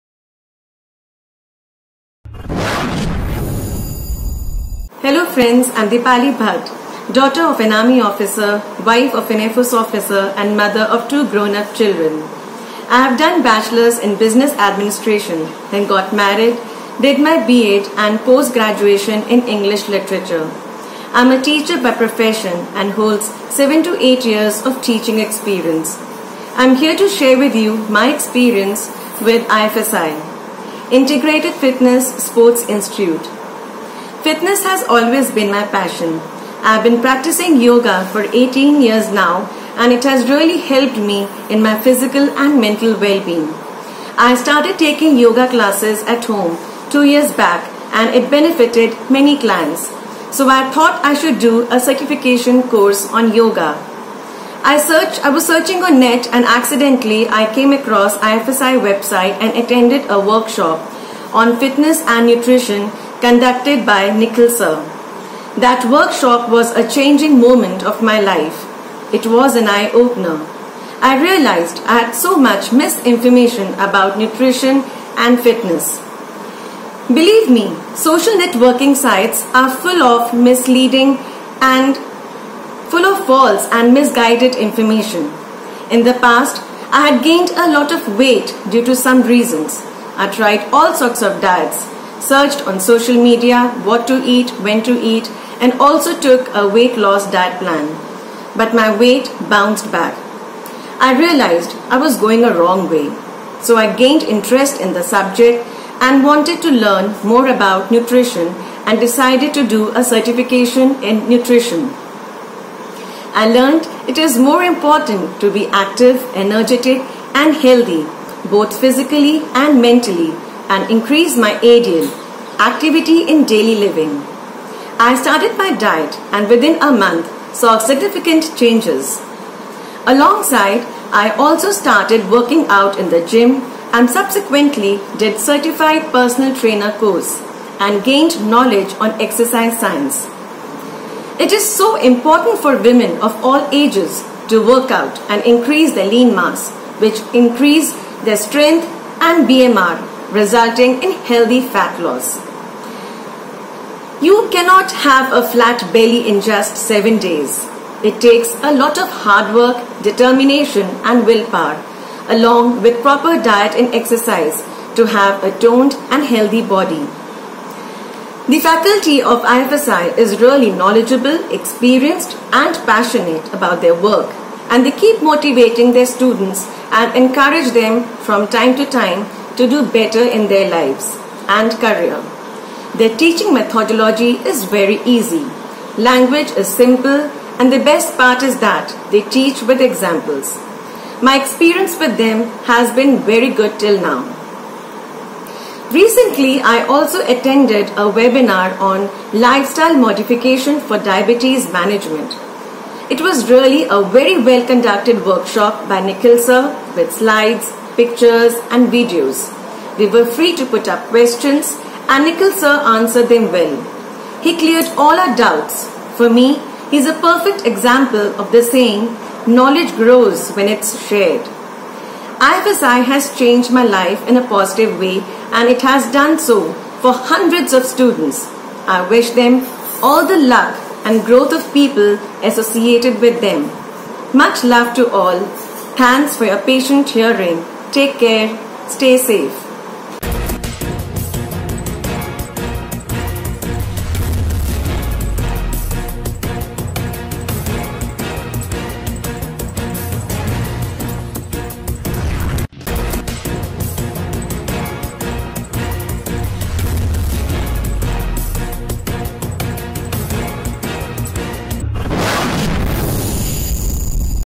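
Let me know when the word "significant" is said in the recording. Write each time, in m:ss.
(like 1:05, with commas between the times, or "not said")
2:07.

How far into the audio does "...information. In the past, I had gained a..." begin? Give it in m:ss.
1:24.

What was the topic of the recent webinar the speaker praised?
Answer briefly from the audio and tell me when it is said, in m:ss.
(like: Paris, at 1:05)
lifestyle modification for diabetes management, at 3:19.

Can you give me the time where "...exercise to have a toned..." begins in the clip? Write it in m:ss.
2:43.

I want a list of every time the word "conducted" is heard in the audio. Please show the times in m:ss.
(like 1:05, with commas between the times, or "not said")
1:03, 3:24.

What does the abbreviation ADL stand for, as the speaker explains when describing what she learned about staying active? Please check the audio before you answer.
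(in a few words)
activity in daily living.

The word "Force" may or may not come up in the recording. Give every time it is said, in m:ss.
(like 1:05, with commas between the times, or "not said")
0:09.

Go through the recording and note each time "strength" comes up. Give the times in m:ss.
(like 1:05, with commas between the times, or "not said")
2:28.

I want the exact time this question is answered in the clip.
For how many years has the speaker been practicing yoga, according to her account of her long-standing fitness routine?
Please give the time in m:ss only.
0:38.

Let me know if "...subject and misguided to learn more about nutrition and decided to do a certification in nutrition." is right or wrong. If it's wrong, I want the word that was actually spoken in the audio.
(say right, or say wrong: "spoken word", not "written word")
wrong: "wanted", not "misguided".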